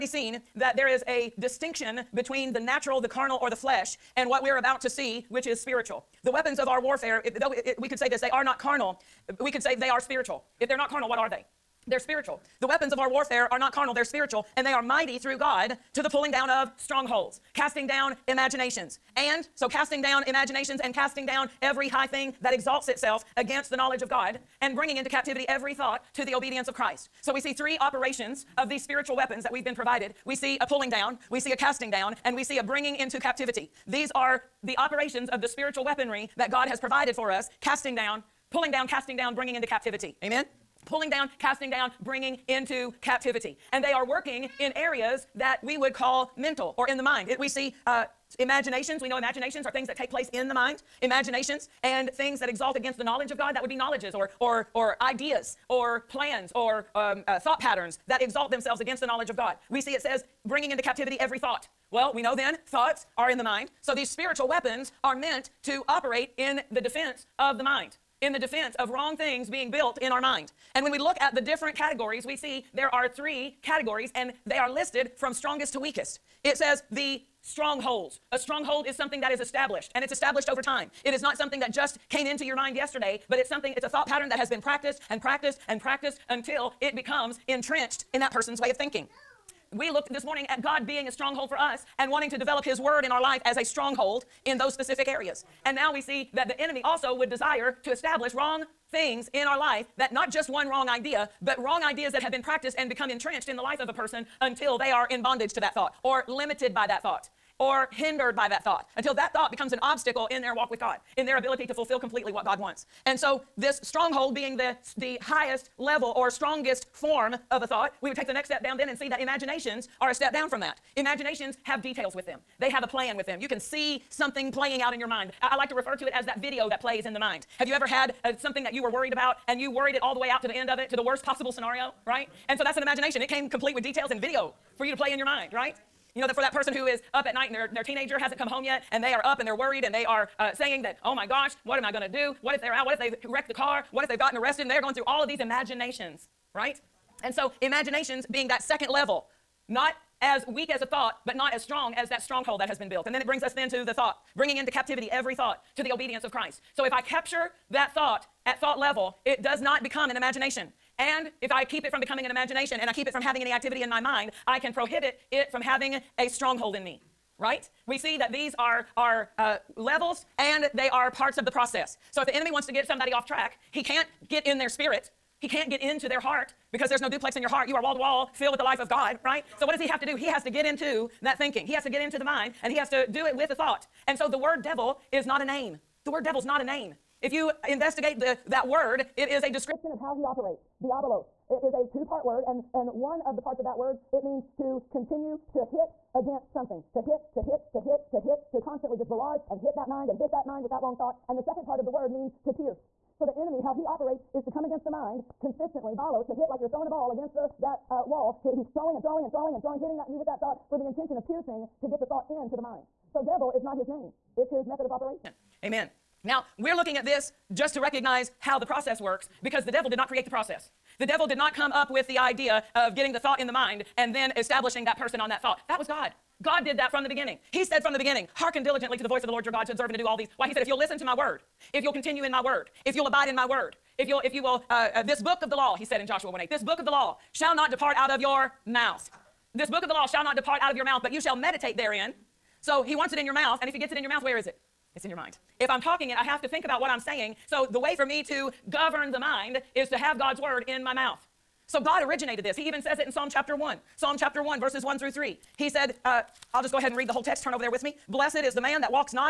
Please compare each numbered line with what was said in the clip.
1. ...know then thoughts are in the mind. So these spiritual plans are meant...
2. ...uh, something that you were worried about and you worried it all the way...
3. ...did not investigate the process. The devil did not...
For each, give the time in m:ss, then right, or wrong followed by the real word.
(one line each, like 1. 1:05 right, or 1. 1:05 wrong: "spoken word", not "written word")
1. 1:02 wrong: "weapons", not "plans"
2. 2:08 right
3. 3:39 wrong: "create", not "investigate".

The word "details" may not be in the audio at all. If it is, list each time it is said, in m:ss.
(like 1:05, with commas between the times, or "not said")
2:01, 2:13.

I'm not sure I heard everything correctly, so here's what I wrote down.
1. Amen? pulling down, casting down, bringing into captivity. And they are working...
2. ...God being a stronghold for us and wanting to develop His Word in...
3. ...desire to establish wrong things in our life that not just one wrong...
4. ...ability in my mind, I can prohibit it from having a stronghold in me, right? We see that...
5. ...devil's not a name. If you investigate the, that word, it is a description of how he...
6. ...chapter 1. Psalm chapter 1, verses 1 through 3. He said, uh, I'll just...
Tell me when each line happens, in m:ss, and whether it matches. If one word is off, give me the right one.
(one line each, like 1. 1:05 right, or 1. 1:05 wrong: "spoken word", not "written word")
1. 0:40 right
2. 1:30 right
3. 1:37 right
4. 2:43 wrong: "activity", not "ability"
5. 3:06 right
6. 4:13 right.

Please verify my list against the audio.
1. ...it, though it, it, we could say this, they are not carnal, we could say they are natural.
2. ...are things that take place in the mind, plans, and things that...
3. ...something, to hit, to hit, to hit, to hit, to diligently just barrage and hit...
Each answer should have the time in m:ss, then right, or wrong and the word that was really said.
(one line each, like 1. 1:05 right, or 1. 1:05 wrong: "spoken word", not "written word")
1. 0:07 wrong: "spiritual", not "natural"
2. 0:49 wrong: "imaginations", not "plans"
3. 3:16 wrong: "constantly", not "diligently".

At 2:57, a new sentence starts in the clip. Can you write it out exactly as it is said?
You are wall to wall filled with the life of God, right?